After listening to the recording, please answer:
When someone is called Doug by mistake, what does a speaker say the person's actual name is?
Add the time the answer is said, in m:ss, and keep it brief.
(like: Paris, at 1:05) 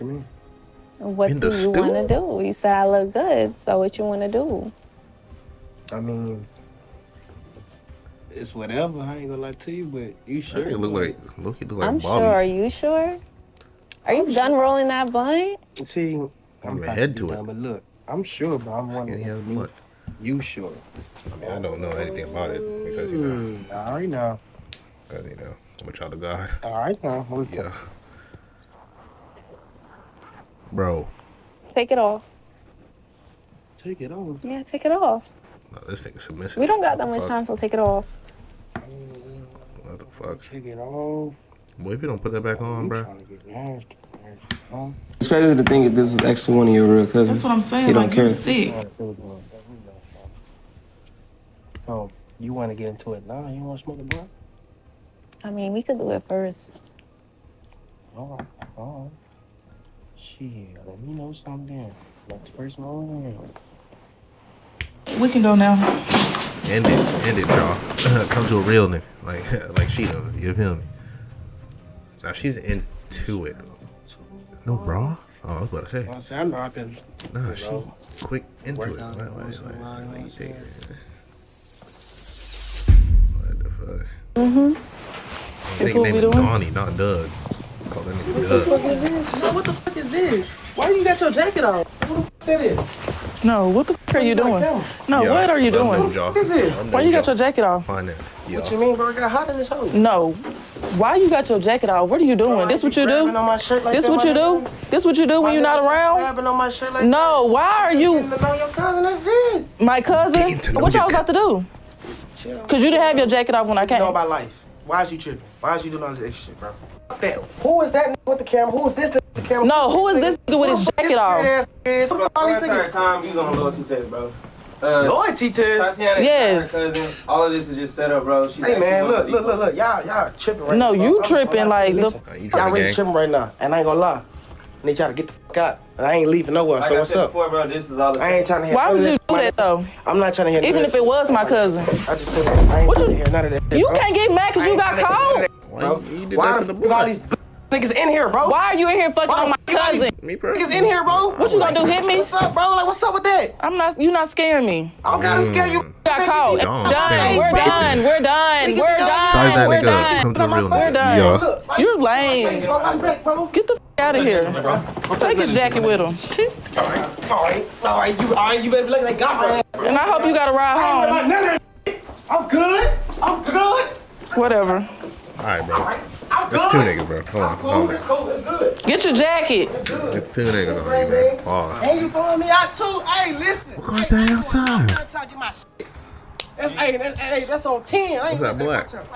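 Donnie, at 1:26.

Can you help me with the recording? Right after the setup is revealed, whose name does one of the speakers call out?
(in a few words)
Tatiana.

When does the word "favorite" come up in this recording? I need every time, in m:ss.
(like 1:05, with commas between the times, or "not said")
not said.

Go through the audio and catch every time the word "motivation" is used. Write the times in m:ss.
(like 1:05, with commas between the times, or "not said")
not said.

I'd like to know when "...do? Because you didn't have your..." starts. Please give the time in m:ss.
1:51.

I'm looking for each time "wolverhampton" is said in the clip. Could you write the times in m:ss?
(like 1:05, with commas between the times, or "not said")
not said.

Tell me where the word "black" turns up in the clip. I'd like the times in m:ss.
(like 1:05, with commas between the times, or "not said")
3:08.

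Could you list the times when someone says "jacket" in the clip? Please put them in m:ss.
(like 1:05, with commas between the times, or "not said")
1:31, 1:37, 1:41, 1:53, 2:00, 2:45, 2:59.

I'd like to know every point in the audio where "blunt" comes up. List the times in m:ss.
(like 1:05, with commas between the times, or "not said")
0:15, 0:19, 0:54.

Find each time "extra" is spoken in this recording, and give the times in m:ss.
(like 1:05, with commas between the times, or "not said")
1:56.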